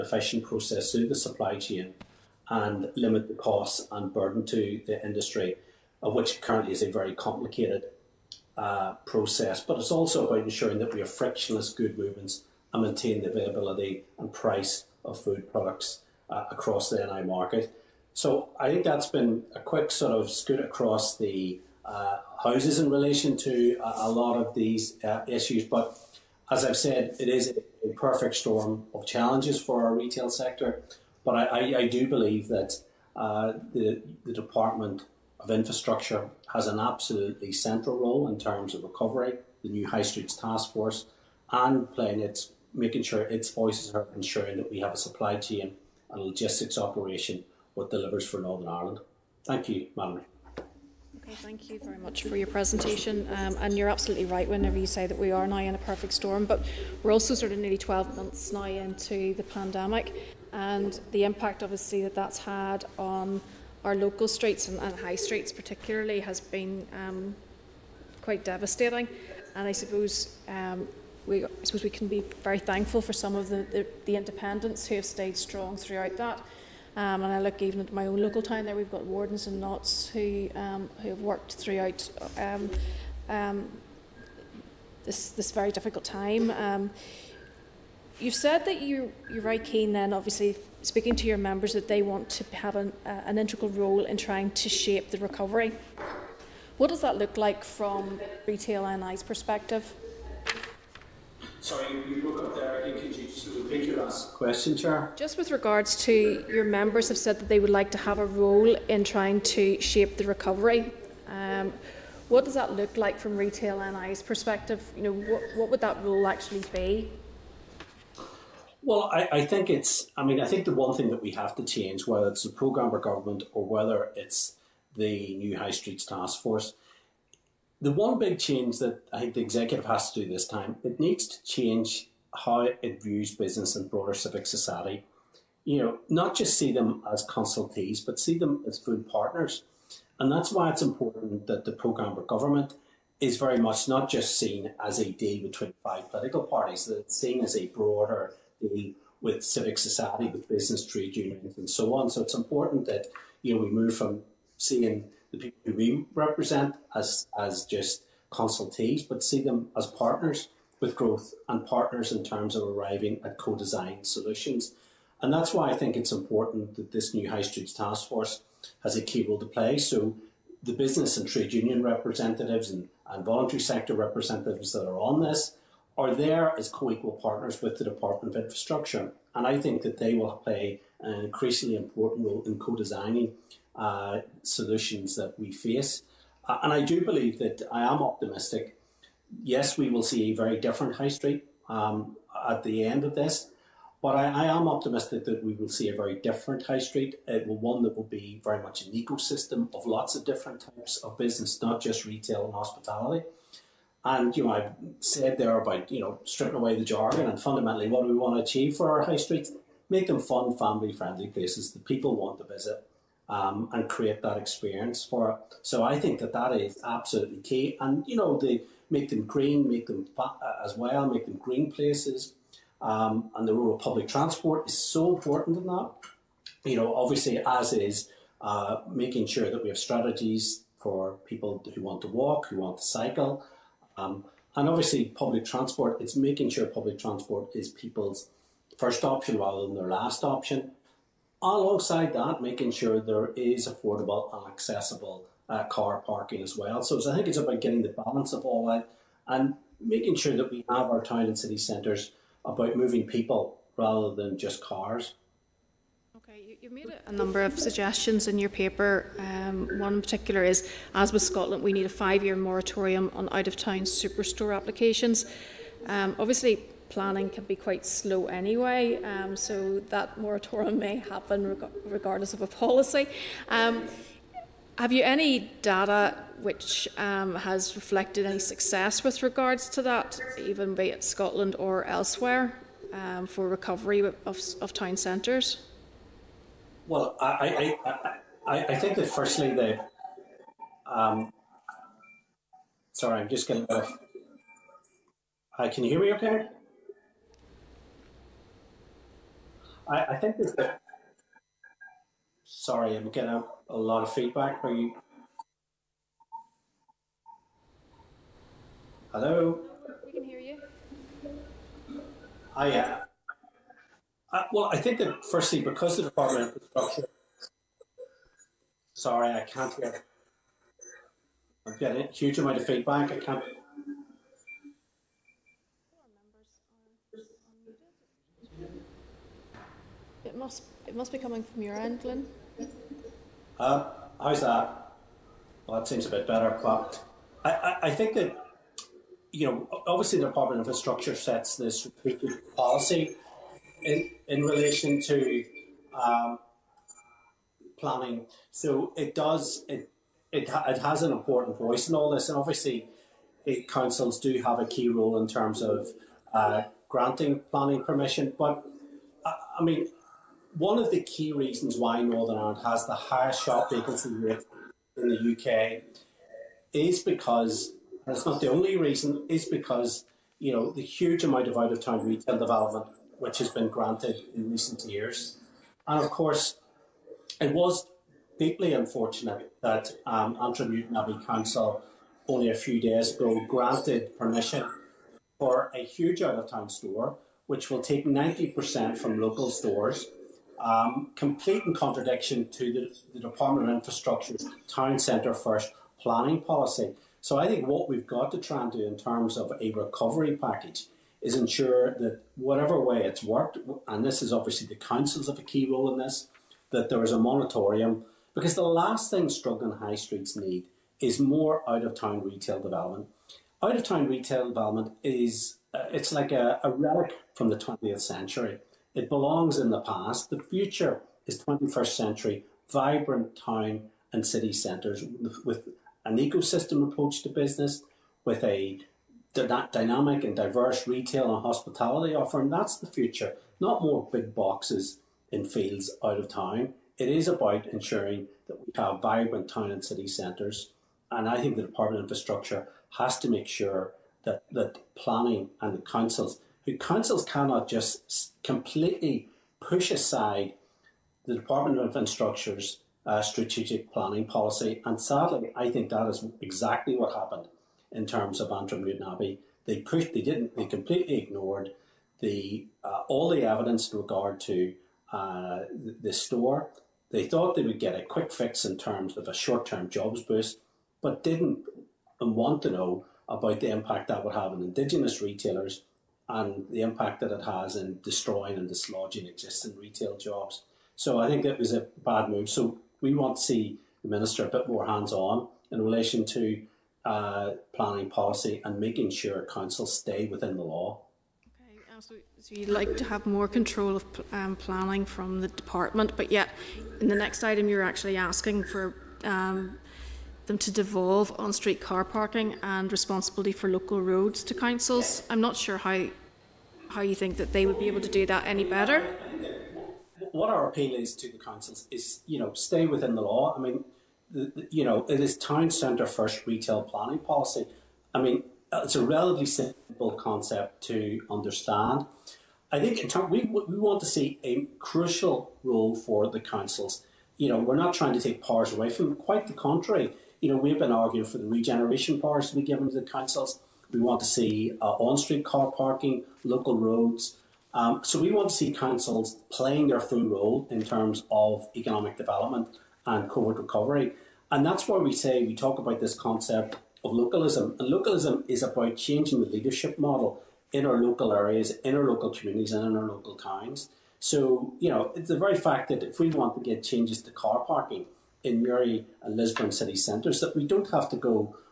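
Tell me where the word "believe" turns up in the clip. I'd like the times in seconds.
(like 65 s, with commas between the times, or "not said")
32 s, 187 s.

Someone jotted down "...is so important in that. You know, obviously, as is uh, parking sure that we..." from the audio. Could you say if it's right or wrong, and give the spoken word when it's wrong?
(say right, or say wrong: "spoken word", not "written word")
wrong: "making", not "parking".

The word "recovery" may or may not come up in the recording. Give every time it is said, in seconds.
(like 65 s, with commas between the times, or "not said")
38 s, 95 s, 110 s, 283 s, 399 s, 543 s.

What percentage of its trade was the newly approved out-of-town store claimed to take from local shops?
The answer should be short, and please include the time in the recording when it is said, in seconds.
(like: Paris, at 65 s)
90%, at 388 s.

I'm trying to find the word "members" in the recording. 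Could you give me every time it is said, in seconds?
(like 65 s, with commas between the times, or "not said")
91 s, 106 s.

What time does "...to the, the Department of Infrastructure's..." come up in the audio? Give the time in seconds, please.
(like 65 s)
392 s.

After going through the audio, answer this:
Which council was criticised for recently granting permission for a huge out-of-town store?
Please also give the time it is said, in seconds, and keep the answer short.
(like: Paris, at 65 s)
Antrim Newtownabbey Council, at 380 s.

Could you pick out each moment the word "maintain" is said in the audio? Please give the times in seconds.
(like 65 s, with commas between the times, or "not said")
12 s.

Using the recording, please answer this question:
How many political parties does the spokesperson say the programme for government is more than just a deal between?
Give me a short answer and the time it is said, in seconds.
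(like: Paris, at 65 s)
5, at 145 s.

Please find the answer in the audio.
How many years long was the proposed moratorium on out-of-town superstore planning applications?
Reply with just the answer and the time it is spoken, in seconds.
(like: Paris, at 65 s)
5, at 261 s.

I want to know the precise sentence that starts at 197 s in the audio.
It will one that will be very much an ecosystem of lots of different types of business, not just retail and hospitality.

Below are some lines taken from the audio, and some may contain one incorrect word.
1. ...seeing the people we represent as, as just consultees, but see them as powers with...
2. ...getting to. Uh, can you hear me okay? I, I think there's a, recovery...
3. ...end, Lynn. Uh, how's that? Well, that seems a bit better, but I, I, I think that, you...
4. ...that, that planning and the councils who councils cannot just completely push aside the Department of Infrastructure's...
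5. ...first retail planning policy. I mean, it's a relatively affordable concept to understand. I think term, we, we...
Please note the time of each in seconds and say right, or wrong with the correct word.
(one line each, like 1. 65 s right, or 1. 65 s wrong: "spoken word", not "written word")
1. 154 s wrong: "partners", not "powers"
2. 293 s wrong: "sorry", not "recovery"
3. 331 s right
4. 444 s right
5. 516 s wrong: "simple", not "affordable".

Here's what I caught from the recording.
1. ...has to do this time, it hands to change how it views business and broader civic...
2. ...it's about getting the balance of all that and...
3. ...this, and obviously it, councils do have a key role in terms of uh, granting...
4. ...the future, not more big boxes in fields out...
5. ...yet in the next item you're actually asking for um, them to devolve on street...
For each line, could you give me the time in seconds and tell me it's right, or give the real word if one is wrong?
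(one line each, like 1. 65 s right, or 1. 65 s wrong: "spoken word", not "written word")
1. 129 s wrong: "needs", not "hands"
2. 247 s right
3. 352 s right
4. 432 s right
5. 496 s right.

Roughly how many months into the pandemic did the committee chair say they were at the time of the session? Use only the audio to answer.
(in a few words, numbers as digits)
12.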